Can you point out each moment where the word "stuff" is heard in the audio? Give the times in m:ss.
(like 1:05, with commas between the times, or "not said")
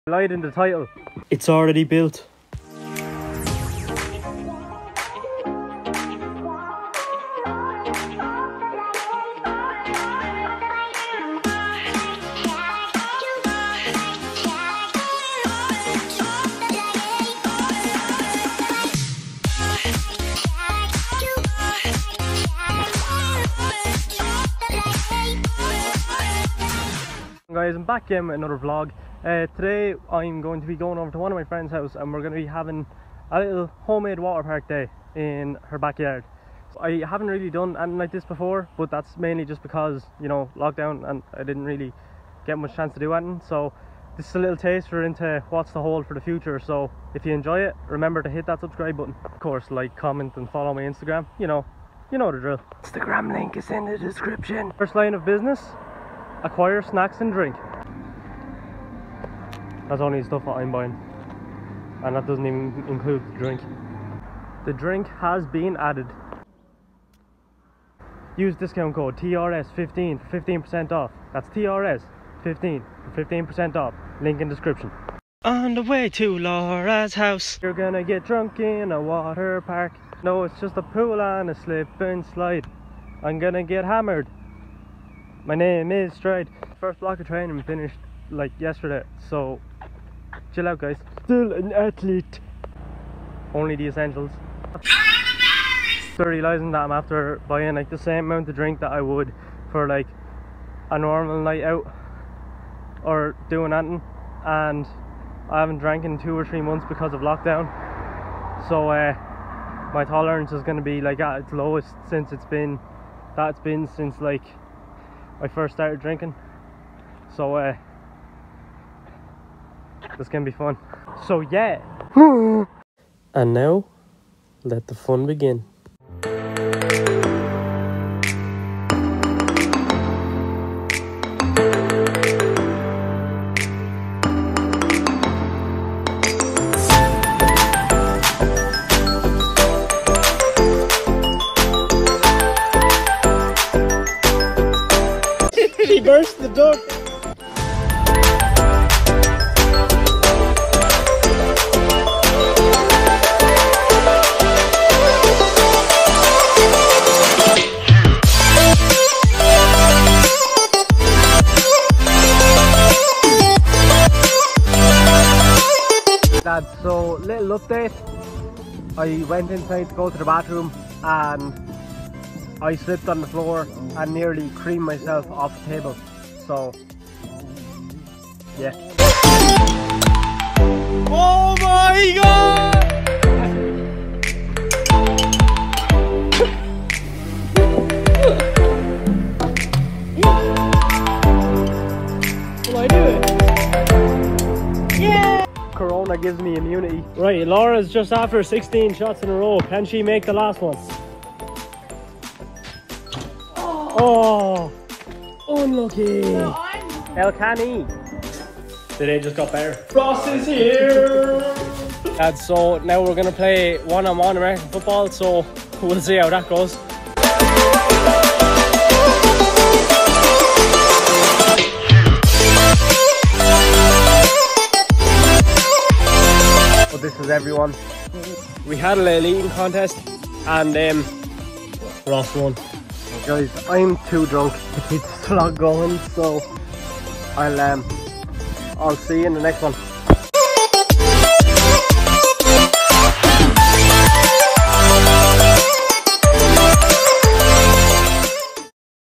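1:00.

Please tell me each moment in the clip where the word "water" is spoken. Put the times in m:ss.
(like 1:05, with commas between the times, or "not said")
0:34, 1:19.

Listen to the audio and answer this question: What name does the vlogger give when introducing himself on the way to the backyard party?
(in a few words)
Stryde.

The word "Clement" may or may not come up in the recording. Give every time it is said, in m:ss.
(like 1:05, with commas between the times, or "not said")
not said.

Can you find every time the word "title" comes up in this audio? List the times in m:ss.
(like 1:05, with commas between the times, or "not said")
0:00.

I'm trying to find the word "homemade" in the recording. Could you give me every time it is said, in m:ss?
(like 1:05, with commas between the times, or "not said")
0:33.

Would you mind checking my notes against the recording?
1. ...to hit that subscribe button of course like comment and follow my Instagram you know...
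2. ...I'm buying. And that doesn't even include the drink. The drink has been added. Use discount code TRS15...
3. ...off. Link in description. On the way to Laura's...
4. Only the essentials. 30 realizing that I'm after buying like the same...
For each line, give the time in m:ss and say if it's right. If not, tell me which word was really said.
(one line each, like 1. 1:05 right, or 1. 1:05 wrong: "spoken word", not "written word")
1. 0:48 right
2. 1:00 right
3. 1:13 right
4. 1:33 right.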